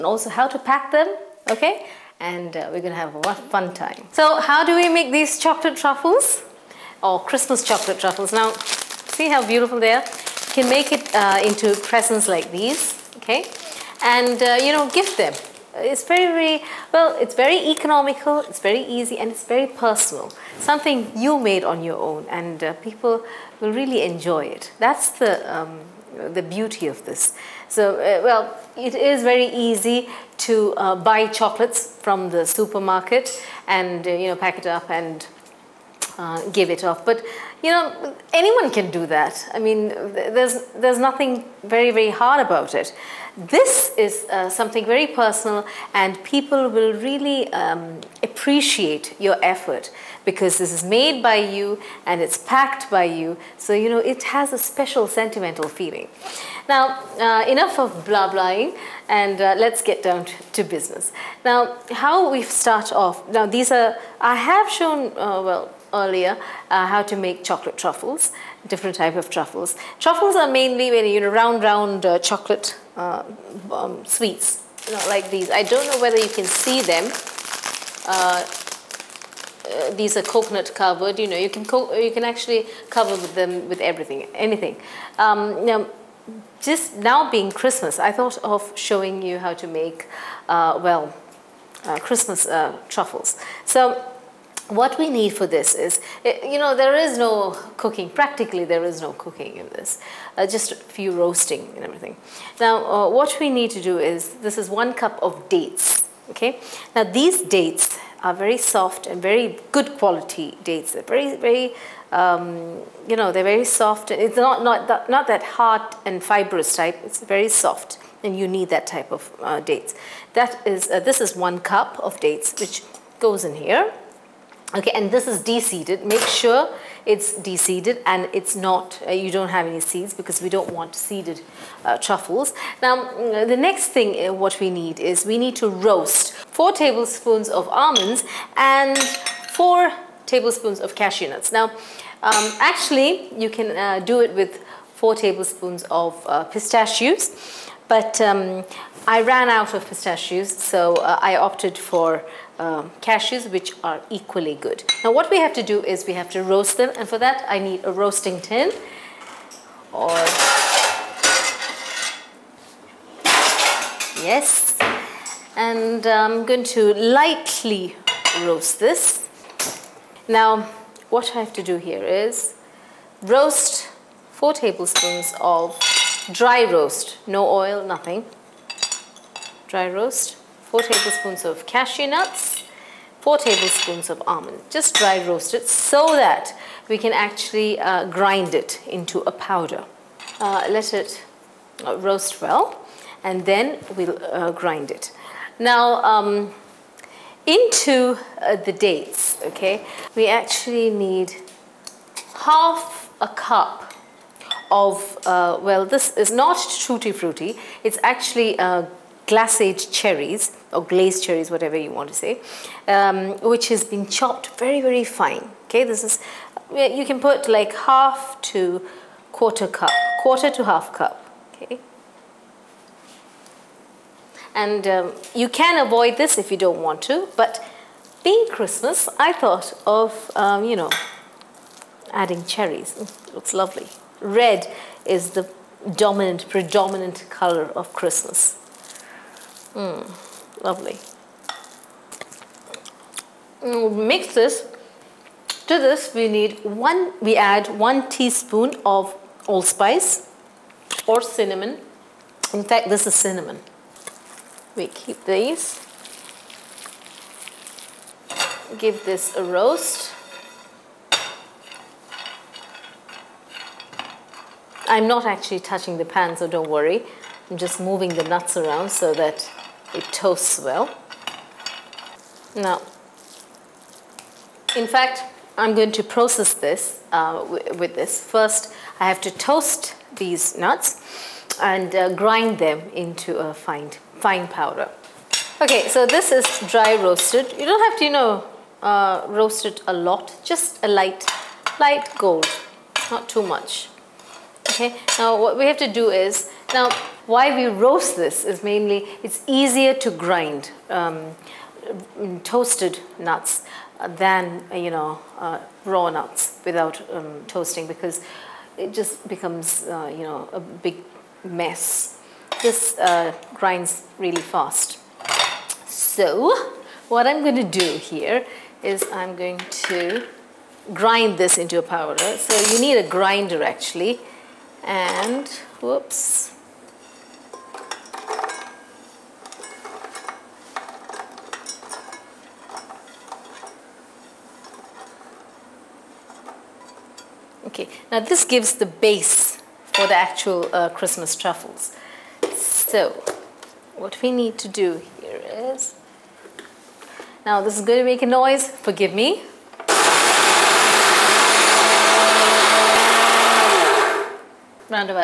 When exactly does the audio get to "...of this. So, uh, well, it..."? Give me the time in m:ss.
0:26.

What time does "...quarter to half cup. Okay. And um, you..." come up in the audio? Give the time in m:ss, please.
3:40.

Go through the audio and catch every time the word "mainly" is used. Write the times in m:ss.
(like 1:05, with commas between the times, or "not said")
1:10, 4:58.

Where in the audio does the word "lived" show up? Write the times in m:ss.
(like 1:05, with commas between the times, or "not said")
not said.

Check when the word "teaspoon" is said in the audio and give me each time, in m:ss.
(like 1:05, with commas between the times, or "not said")
4:08.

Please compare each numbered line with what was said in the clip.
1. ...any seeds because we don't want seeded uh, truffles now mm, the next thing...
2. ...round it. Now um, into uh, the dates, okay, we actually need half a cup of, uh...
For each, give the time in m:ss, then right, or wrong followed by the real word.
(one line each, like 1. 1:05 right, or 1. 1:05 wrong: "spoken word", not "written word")
1. 2:09 right
2. 3:14 wrong: "grind", not "round".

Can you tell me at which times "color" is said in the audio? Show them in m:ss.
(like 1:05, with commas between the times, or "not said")
3:57.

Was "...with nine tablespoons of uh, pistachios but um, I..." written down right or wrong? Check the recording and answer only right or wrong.
wrong.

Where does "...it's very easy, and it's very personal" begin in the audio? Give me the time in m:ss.
0:18.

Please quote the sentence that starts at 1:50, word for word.
They're very, very, um, you know, they're very soft.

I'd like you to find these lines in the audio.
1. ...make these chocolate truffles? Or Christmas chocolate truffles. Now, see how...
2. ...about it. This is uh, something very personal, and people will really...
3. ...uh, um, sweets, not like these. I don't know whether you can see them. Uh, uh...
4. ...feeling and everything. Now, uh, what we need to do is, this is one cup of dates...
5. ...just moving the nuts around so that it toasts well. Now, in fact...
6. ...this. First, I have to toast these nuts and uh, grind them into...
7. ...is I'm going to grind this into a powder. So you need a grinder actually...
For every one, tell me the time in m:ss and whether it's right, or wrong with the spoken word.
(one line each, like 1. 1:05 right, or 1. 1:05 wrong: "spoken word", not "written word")
1. 0:04 right
2. 0:42 right
3. 1:12 right
4. 1:41 wrong: "roasting", not "feeling"
5. 4:27 right
6. 4:37 right
7. 5:18 right.